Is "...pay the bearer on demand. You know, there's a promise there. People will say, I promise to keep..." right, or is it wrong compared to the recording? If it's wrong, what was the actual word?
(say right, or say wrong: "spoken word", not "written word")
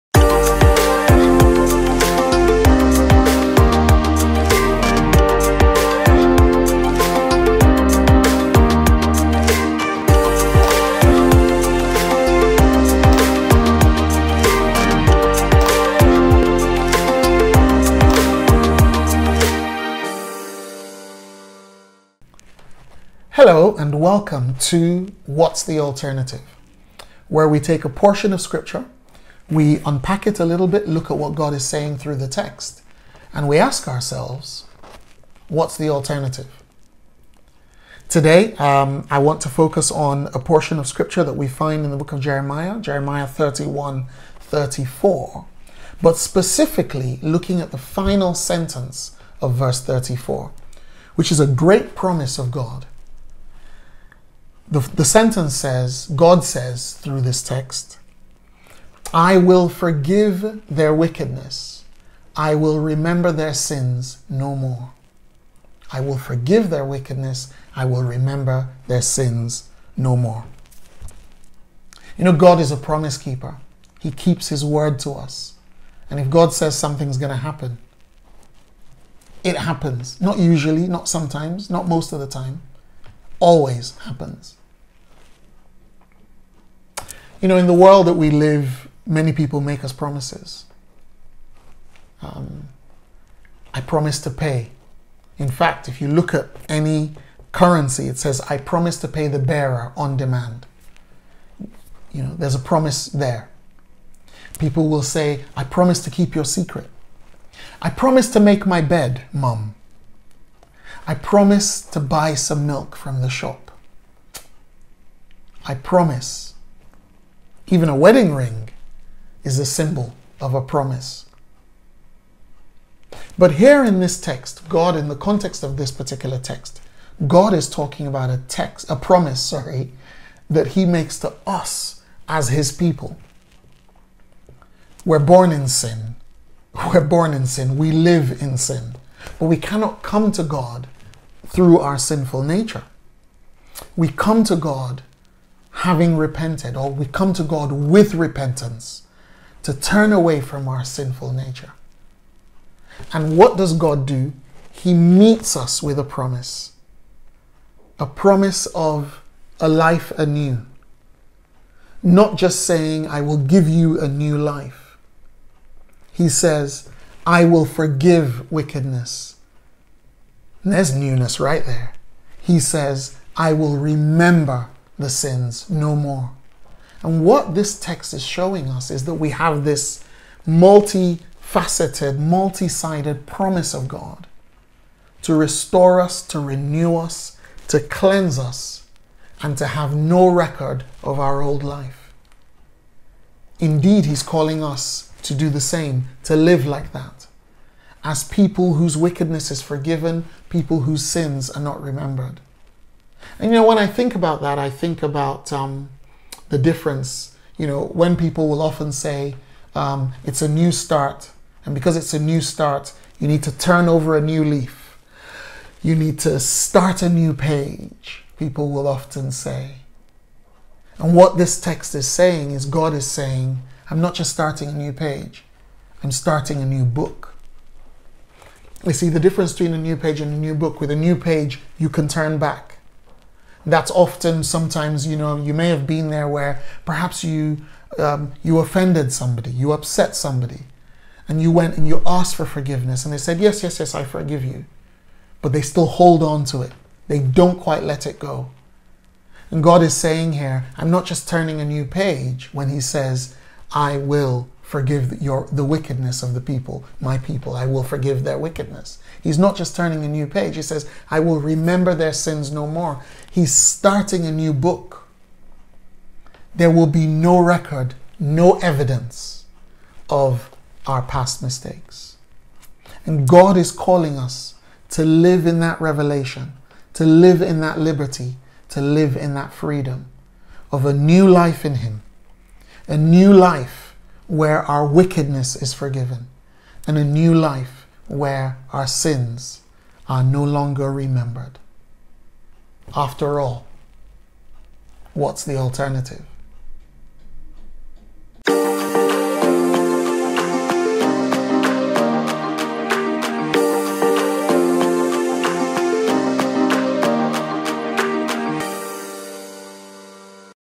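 right.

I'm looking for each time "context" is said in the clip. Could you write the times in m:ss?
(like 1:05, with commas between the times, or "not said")
2:05.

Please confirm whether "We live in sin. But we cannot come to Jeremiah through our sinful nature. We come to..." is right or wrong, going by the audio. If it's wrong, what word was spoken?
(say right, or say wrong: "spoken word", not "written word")
wrong: "God", not "Jeremiah".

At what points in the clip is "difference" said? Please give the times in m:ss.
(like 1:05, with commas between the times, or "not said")
3:26, 3:49.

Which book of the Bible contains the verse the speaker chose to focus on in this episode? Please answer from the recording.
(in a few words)
Jeremiah.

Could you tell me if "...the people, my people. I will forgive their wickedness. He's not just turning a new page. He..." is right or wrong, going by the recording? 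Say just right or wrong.
right.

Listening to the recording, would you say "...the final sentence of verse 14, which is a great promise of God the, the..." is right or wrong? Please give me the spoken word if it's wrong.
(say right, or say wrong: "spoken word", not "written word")
wrong: "34", not "14".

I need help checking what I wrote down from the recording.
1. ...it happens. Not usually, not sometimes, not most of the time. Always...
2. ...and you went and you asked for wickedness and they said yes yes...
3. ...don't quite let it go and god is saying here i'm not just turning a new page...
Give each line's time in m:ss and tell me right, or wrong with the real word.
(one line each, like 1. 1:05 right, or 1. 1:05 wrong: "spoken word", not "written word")
1. 1:19 right
2. 4:01 wrong: "forgiveness", not "wickedness"
3. 4:07 right.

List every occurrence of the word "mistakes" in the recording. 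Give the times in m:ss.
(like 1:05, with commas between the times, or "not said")
4:31.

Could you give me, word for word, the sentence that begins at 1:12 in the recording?
You know, God is a promise keeper.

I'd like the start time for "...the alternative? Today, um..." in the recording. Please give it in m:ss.
0:35.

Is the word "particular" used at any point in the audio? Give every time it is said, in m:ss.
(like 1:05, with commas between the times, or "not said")
2:05.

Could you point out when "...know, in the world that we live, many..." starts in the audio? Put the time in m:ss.
1:27.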